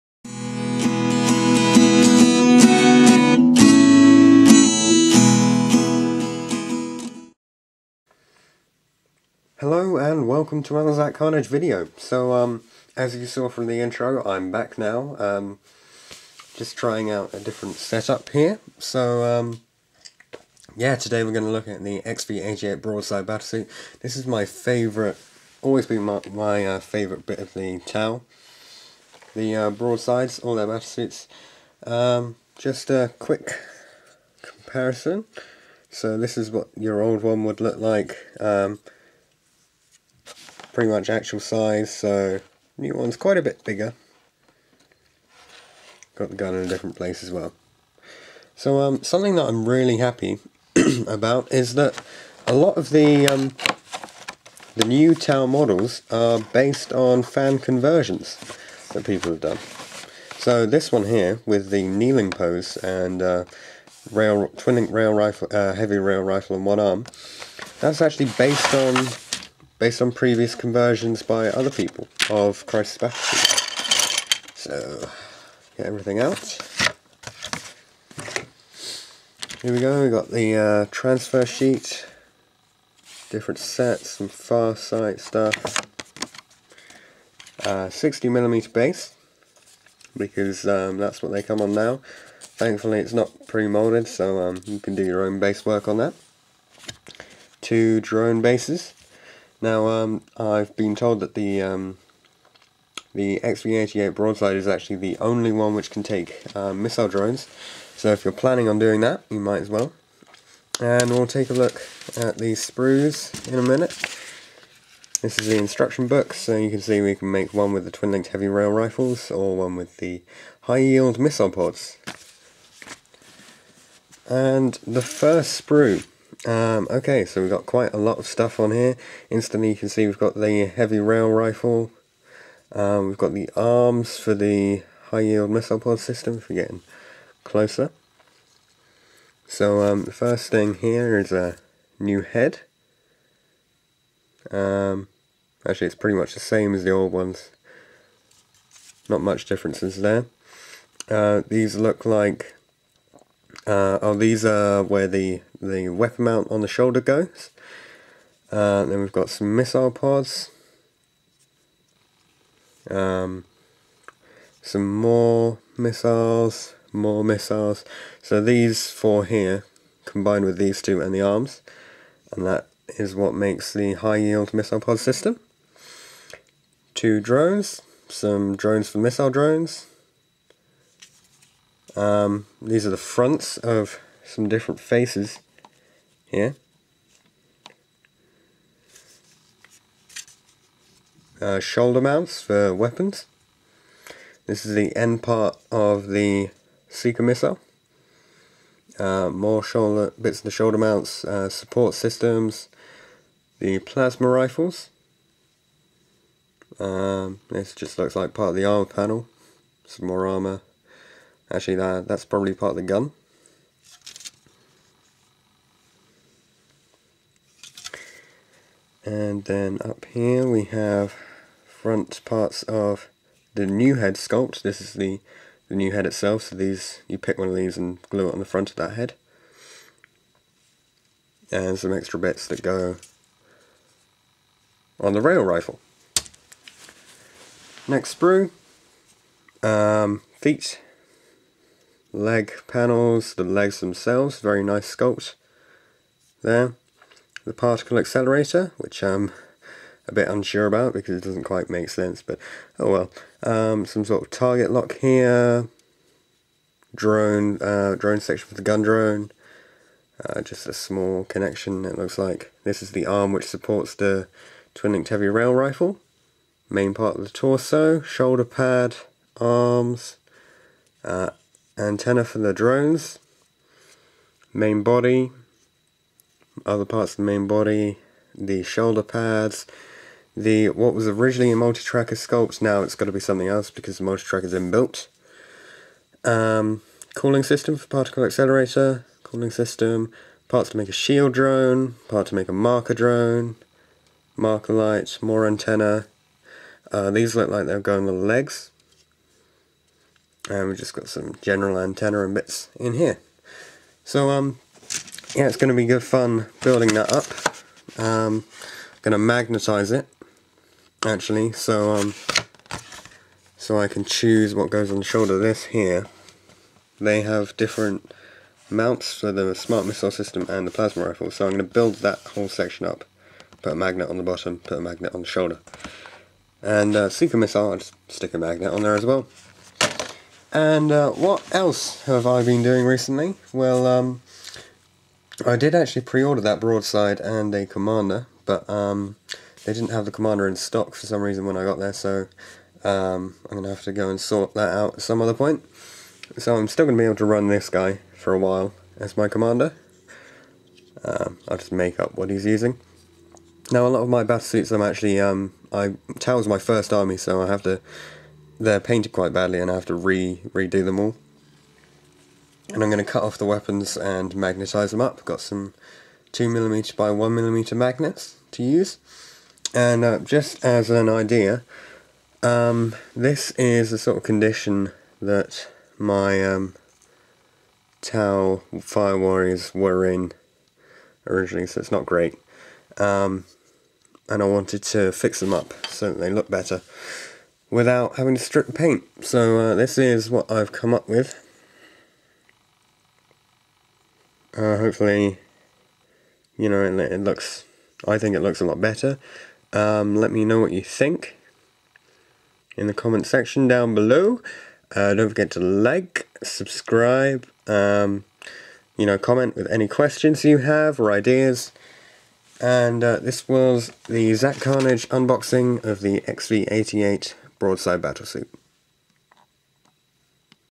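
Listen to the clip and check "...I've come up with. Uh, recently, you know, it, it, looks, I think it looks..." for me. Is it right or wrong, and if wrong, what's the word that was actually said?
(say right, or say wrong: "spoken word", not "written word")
wrong: "hopefully", not "recently".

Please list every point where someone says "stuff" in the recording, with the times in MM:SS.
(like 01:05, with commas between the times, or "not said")
01:25, 02:08.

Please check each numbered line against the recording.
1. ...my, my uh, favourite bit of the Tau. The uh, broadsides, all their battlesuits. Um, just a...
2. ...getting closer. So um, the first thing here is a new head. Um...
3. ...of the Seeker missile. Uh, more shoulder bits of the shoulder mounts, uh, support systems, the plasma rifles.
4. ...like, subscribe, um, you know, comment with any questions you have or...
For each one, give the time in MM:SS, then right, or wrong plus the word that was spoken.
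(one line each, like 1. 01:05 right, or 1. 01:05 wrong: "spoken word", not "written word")
1. 00:26 right
2. 02:16 right
3. 03:15 right
4. 06:45 right.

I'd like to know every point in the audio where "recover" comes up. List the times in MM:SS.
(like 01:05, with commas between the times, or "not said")
not said.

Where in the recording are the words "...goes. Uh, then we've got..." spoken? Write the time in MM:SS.
02:37.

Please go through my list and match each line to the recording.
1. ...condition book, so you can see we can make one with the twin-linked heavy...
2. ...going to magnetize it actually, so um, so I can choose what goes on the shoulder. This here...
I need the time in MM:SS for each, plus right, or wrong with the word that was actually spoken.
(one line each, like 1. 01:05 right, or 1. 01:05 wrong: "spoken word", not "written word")
1. 01:55 wrong: "instruction", not "condition"
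2. 05:09 right.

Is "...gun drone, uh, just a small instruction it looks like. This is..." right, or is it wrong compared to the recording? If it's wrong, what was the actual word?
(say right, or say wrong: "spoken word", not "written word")
wrong: "connection", not "instruction".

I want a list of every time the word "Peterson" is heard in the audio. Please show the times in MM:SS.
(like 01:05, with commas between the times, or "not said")
not said.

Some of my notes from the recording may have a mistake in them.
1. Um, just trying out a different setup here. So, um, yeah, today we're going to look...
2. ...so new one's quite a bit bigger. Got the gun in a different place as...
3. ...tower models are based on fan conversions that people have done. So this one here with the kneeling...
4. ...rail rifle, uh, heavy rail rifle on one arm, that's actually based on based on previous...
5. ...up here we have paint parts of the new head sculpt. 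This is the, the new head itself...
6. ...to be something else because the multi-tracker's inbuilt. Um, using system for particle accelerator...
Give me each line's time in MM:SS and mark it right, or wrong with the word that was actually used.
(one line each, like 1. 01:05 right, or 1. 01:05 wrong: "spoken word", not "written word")
1. 00:15 right
2. 00:41 right
3. 00:55 right
4. 01:04 right
5. 03:39 wrong: "front", not "paint"
6. 04:43 wrong: "cooling", not "using".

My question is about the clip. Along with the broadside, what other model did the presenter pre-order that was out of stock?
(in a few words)
a commander.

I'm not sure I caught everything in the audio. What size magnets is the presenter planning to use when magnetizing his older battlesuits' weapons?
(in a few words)
2mm by 1mm.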